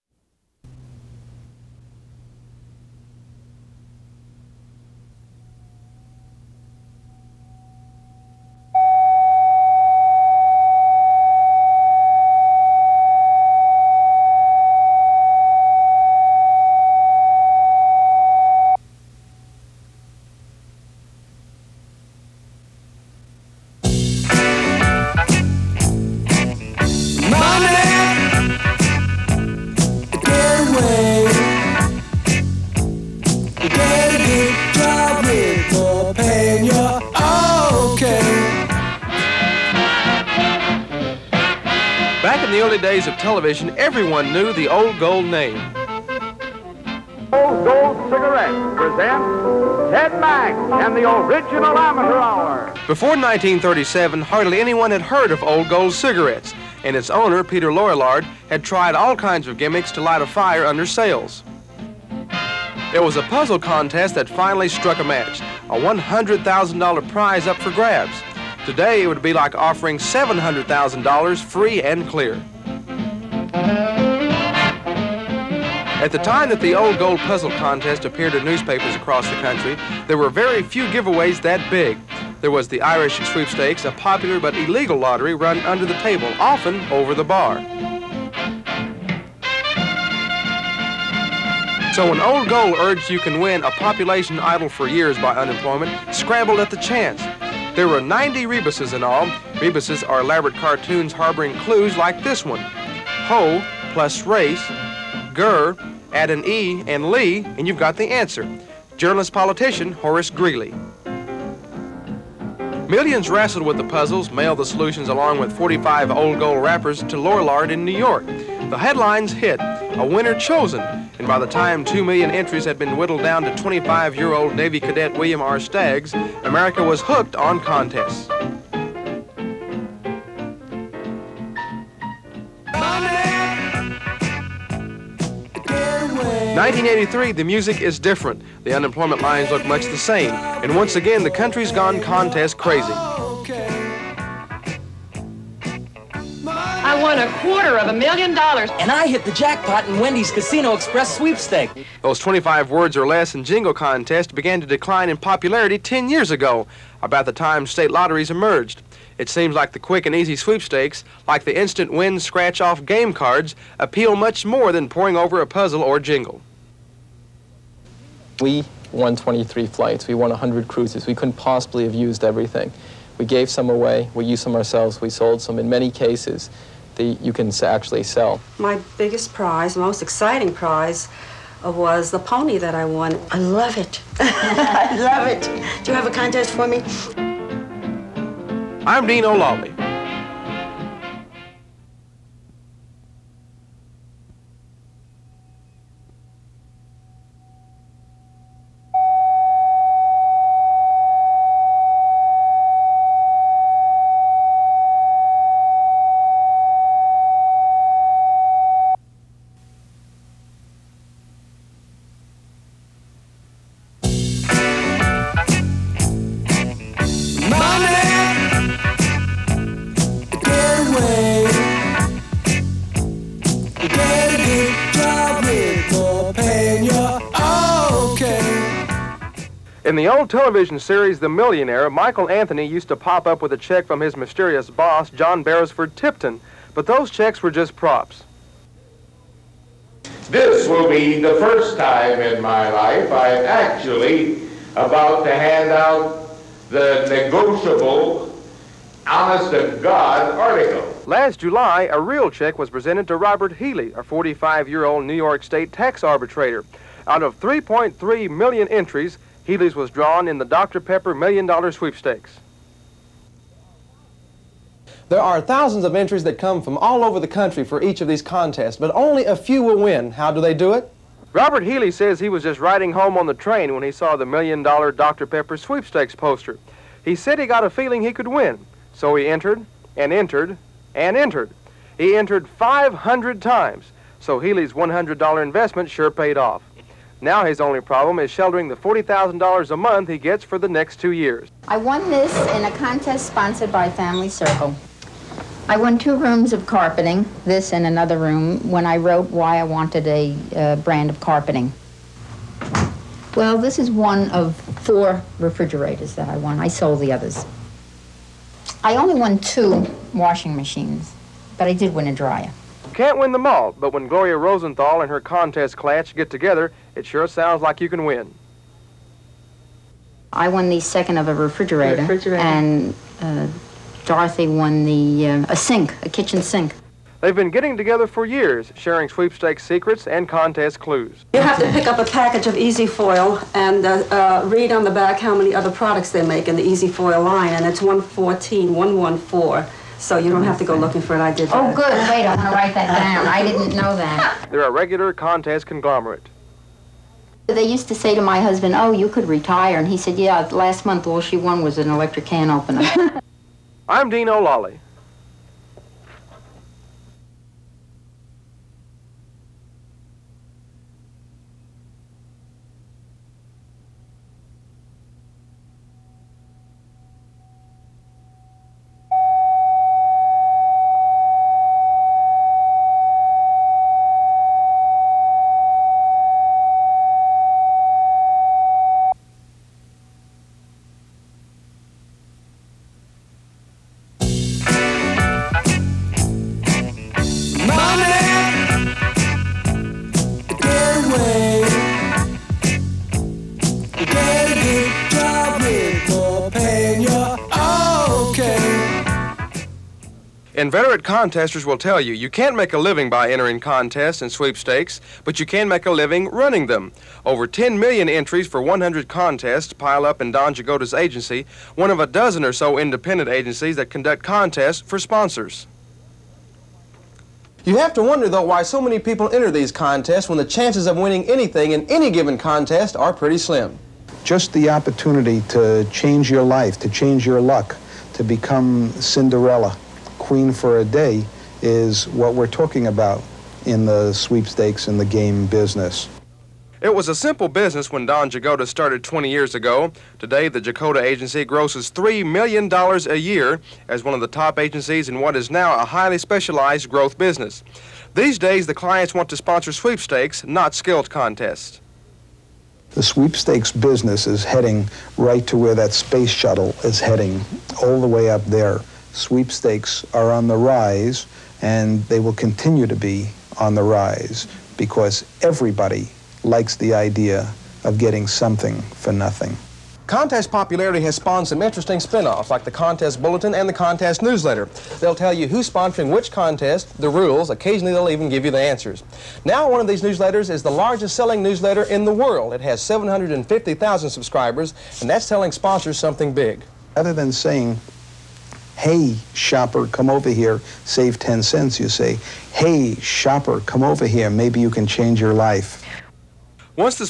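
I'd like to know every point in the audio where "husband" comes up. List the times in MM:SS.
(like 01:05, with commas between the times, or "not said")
05:48.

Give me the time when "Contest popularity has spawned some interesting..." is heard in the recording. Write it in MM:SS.
07:50.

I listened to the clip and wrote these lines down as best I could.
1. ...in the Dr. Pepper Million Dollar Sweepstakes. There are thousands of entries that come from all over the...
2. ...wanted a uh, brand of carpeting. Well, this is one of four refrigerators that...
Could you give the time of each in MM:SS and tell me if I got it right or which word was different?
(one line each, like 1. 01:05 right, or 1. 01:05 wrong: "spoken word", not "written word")
1. 04:20 right
2. 04:59 right.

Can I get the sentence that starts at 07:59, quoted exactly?
Now one of these newsletters is the largest selling newsletter in the world.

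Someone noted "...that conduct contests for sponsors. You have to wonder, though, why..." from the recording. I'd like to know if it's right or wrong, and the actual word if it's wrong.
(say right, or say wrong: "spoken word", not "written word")
right.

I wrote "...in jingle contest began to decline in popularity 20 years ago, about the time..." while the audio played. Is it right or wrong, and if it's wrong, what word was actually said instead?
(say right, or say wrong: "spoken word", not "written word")
wrong: "10", not "20".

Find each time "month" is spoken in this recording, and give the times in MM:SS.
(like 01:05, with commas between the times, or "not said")
04:49, 05:50.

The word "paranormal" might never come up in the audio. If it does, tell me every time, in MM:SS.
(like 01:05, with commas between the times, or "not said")
not said.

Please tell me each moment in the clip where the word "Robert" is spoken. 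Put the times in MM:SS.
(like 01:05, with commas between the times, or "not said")
04:13, 04:31.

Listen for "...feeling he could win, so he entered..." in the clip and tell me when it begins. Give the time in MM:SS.
04:37.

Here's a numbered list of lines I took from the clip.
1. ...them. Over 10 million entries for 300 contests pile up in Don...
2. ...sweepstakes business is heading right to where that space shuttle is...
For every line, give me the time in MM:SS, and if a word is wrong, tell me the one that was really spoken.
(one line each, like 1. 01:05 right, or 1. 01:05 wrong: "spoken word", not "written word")
1. 06:46 wrong: "100", not "300"
2. 07:33 right.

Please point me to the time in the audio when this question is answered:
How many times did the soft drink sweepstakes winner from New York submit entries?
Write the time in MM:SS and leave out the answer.
04:42.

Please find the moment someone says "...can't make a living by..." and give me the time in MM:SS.
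06:42.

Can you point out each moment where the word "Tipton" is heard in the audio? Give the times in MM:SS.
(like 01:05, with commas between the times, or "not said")
03:55.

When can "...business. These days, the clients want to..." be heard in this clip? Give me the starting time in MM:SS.
07:27.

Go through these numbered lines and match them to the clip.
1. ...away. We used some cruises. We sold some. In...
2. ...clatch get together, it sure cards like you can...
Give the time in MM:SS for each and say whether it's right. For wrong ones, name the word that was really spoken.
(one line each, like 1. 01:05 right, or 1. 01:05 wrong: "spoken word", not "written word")
1. 02:53 wrong: "ourselves", not "cruises"
2. 05:15 wrong: "sounds", not "cards".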